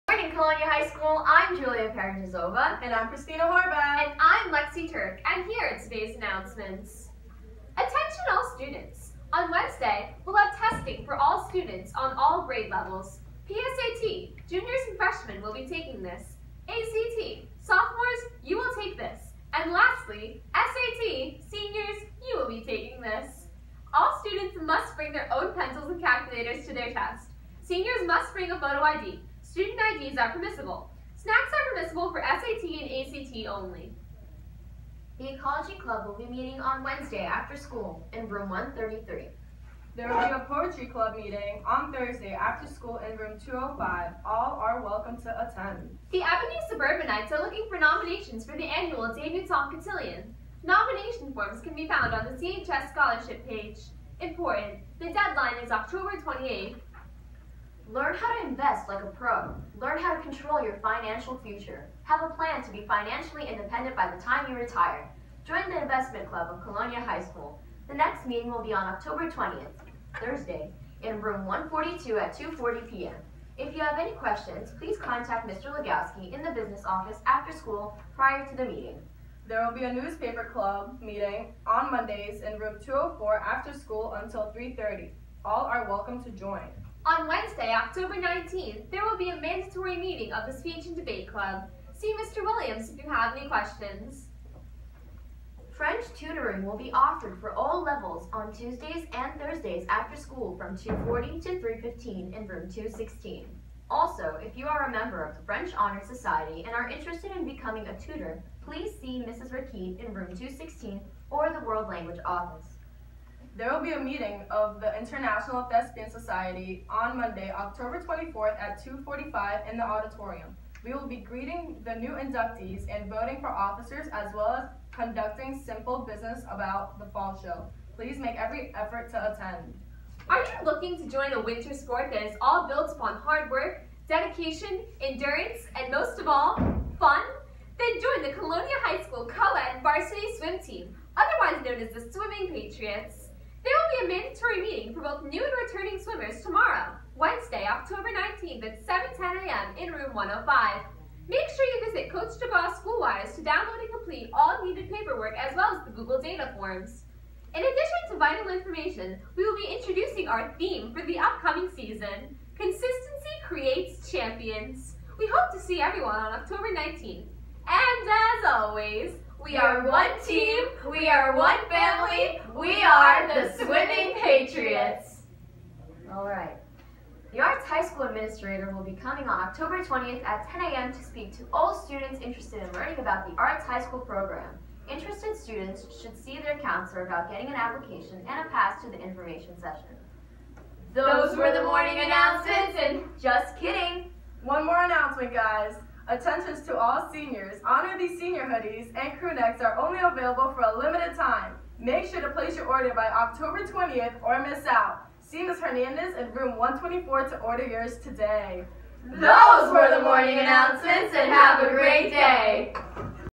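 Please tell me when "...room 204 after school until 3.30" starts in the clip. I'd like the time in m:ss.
1:22.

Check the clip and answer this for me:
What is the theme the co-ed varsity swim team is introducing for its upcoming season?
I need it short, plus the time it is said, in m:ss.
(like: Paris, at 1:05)
Consistency Creates Champions, at 2:42.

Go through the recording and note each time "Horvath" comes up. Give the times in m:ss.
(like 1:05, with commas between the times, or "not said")
0:03.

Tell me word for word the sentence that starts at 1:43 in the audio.
Also, if you are a member of the French Honor Society and are interested in becoming a tutor, please see Mrs.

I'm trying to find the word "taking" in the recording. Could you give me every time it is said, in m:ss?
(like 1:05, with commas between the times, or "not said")
0:15, 0:22.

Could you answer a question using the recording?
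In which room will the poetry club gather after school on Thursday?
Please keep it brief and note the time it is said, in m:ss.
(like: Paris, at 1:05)
205, at 0:43.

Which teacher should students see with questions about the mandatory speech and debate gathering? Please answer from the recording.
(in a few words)
Mr. Williams.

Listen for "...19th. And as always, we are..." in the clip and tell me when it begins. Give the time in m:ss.
2:46.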